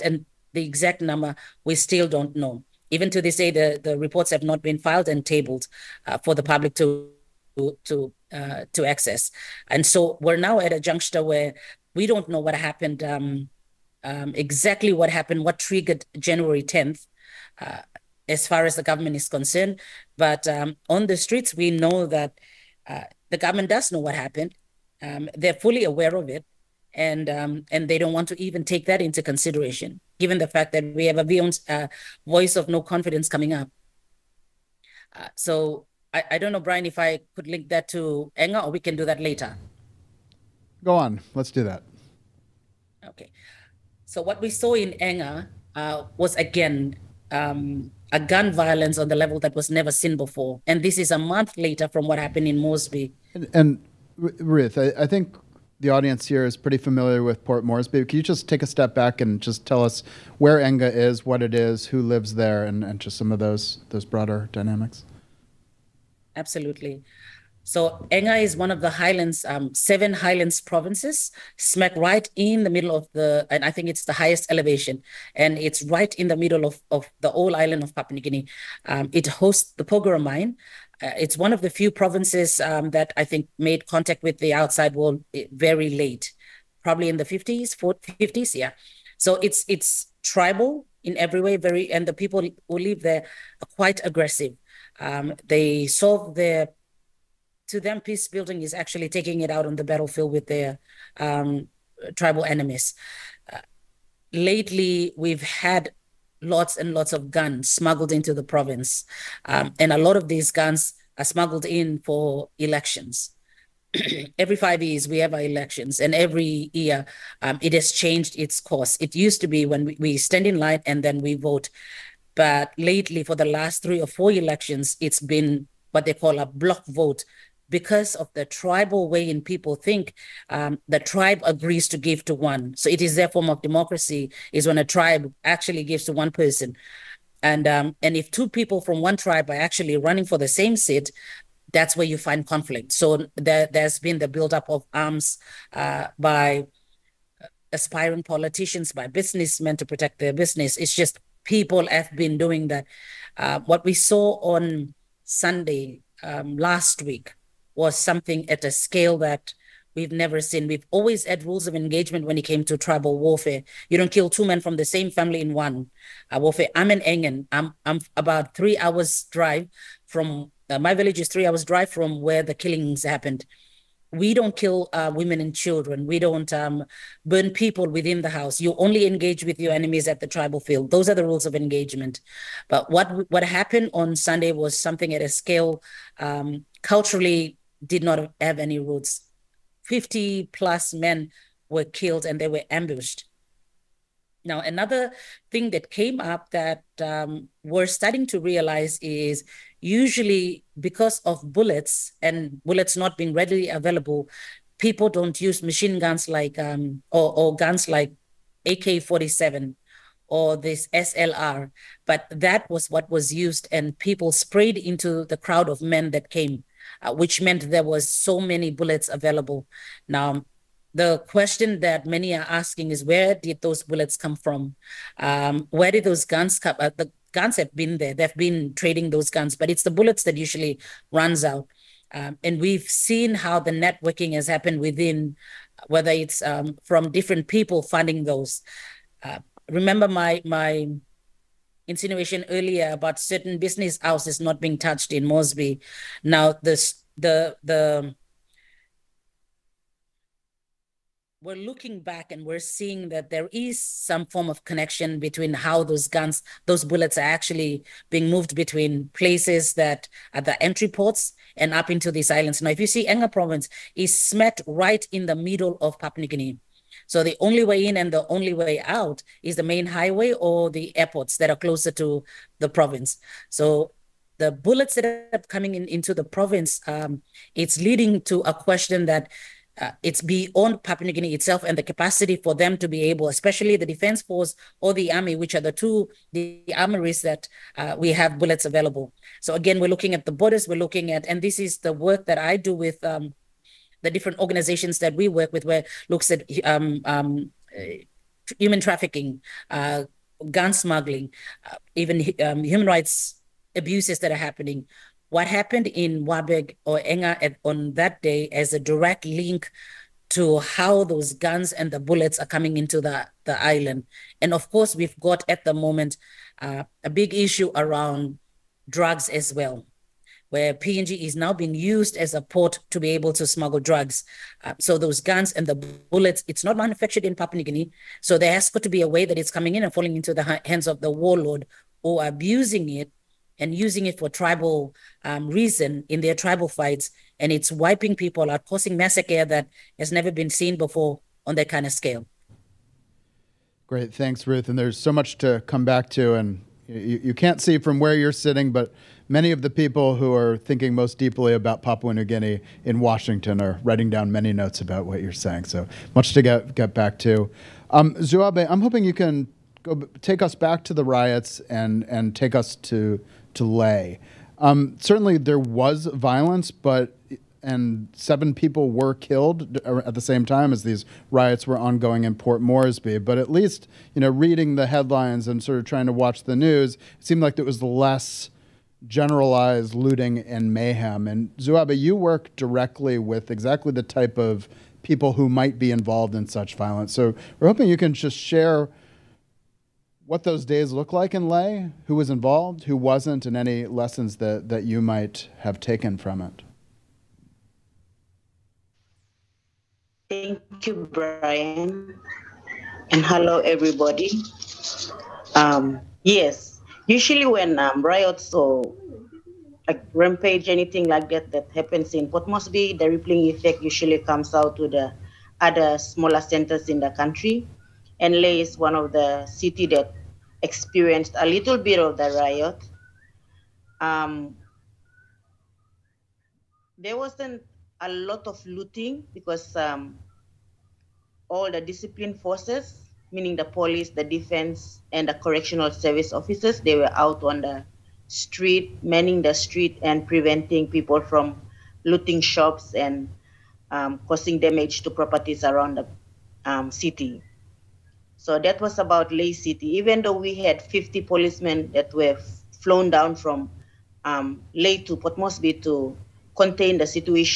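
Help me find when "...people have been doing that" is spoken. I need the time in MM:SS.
02:31.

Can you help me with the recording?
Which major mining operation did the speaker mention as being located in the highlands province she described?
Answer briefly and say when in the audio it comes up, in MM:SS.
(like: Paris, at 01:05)
Porgera mine, at 01:19.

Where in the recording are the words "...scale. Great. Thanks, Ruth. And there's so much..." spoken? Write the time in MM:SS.
05:41.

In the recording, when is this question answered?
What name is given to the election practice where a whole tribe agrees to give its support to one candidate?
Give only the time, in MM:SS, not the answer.
02:06.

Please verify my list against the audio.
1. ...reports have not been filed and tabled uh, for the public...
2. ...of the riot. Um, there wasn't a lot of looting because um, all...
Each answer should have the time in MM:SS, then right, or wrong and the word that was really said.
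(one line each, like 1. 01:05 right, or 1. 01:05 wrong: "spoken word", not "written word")
1. 00:03 right
2. 07:01 right.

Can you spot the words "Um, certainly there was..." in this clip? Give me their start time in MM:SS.
06:04.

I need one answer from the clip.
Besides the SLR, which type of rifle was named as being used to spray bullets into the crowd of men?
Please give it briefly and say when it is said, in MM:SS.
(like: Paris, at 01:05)
AK 47, at 03:28.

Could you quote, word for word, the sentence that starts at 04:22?
Now, if you see Enga province, is smet right in the middle of Papua New Guinea.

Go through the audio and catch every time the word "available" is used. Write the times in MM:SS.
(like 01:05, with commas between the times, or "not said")
03:23, 03:39, 04:48.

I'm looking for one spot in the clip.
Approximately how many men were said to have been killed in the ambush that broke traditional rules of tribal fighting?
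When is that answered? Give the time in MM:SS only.
03:09.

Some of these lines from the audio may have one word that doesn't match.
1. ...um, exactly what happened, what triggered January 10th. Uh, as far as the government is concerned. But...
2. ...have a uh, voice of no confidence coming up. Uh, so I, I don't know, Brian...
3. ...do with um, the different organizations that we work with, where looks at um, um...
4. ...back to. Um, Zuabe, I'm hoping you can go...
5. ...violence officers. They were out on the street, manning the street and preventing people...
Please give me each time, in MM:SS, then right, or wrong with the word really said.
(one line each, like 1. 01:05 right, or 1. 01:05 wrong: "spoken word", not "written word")
1. 00:14 right
2. 00:31 right
3. 04:52 right
4. 05:56 right
5. 07:15 wrong: "service", not "violence".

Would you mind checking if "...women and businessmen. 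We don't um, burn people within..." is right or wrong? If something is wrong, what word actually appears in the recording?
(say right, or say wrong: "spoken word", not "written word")
wrong: "children", not "businessmen".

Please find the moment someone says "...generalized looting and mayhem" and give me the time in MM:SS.
06:19.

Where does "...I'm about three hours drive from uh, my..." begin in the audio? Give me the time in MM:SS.
02:47.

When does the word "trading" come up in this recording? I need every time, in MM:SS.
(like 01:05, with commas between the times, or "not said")
03:48.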